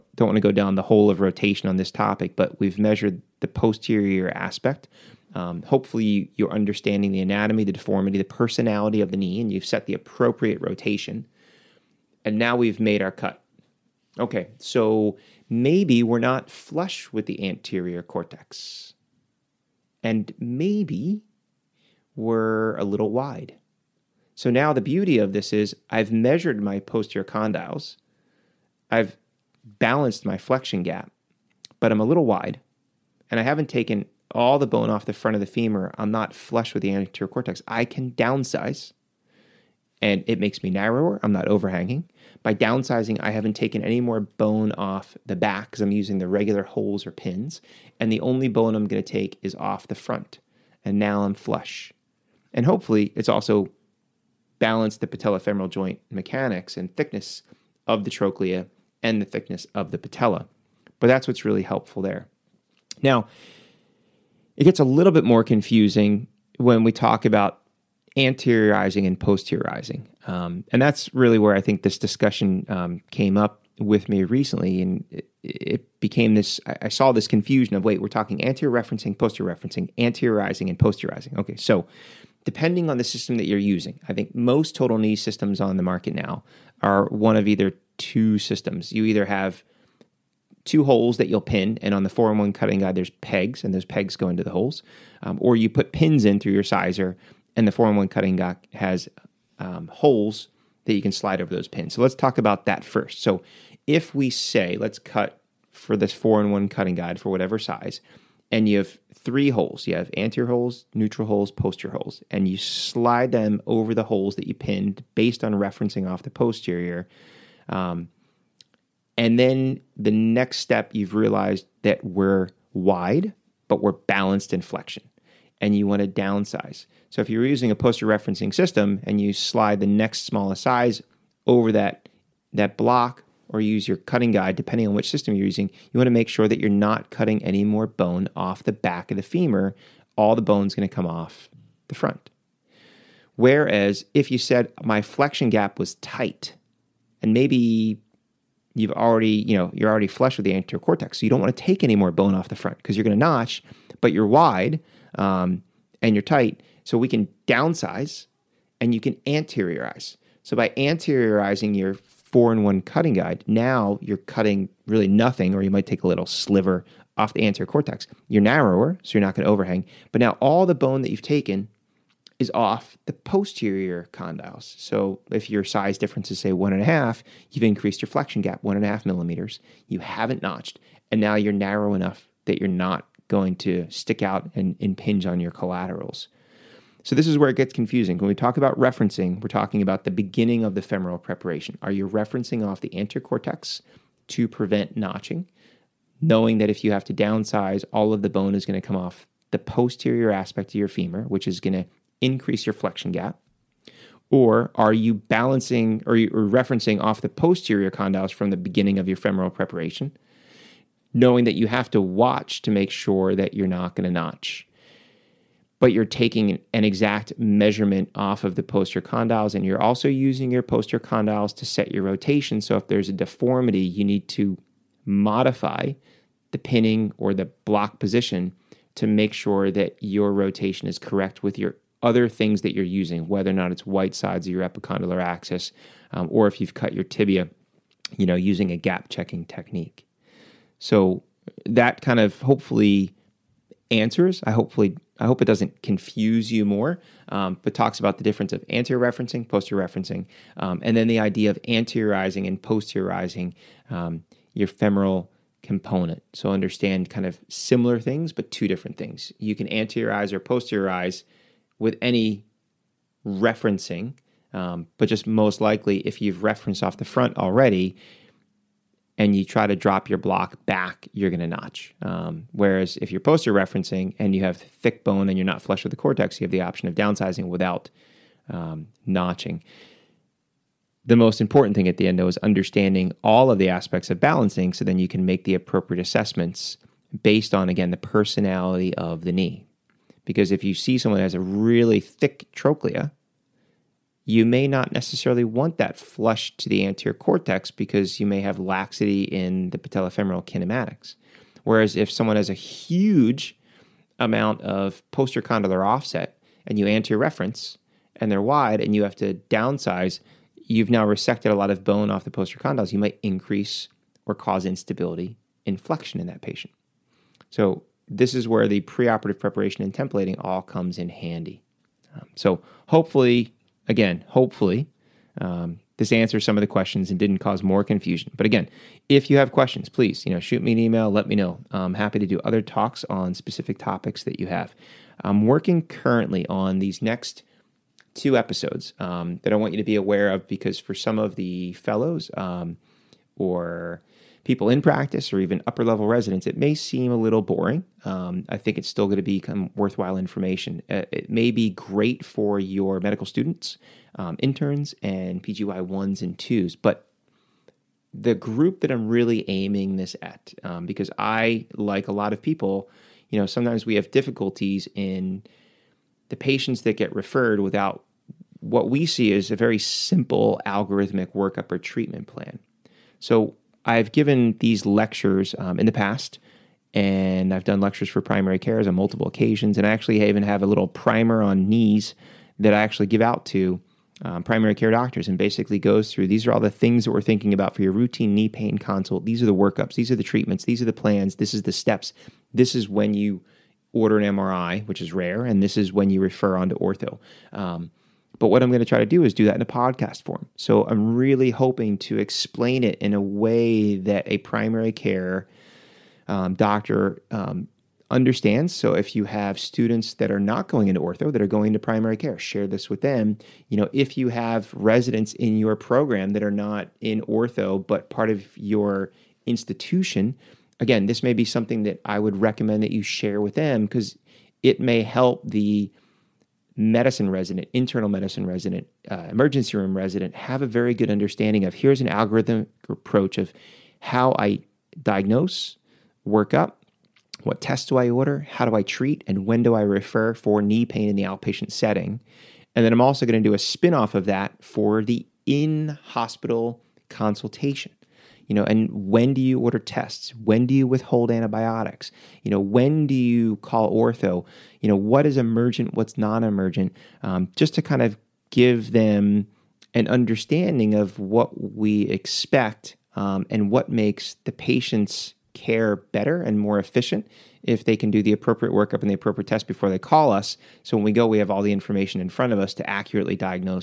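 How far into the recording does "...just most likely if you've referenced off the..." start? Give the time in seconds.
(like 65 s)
265 s.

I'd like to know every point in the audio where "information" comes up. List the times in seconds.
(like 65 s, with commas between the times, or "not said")
350 s, 471 s.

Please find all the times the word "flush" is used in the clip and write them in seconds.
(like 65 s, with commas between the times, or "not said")
16 s, 36 s, 51 s, 150 s, 275 s, 295 s.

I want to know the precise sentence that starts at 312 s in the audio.
You might increase or cause instability in flexion in that patient.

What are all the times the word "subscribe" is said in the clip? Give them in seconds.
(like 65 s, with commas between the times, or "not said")
not said.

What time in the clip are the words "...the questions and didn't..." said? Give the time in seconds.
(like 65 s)
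326 s.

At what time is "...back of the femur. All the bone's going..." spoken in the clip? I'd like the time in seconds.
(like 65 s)
138 s.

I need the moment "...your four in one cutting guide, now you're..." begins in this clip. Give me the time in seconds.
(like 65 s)
161 s.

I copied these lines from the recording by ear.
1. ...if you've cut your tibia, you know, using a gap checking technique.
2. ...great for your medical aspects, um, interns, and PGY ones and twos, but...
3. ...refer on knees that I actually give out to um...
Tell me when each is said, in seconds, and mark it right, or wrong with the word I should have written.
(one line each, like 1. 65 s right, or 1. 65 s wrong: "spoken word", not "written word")
1. 236 s right
2. 351 s wrong: "students", not "aspects"
3. 380 s wrong: "primer", not "refer".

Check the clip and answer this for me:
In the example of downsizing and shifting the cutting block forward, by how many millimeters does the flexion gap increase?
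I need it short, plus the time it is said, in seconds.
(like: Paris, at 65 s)
1.5, at 178 s.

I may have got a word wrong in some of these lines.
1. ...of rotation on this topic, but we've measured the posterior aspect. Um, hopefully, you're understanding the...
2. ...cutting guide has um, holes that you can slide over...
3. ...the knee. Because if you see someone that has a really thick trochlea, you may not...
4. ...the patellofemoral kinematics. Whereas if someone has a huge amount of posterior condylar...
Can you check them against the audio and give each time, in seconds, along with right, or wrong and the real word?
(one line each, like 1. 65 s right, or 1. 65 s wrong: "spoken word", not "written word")
1. 1 s right
2. 98 s right
3. 289 s right
4. 299 s right.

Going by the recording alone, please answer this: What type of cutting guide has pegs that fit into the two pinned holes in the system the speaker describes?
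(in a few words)
4 in 1 cutting guide.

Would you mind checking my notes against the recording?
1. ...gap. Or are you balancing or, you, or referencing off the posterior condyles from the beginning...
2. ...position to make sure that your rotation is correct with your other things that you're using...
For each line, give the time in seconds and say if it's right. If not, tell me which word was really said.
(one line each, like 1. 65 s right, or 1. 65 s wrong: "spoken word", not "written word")
1. 203 s right
2. 227 s right.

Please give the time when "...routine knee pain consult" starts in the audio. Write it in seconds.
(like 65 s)
387 s.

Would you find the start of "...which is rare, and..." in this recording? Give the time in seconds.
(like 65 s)
394 s.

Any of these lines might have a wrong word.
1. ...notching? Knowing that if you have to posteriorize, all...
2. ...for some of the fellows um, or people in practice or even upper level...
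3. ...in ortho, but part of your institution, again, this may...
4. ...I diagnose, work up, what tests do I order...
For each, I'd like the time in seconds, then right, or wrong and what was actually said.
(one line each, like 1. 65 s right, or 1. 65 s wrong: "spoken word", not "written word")
1. 194 s wrong: "downsize", not "posteriorize"
2. 340 s right
3. 417 s right
4. 434 s right.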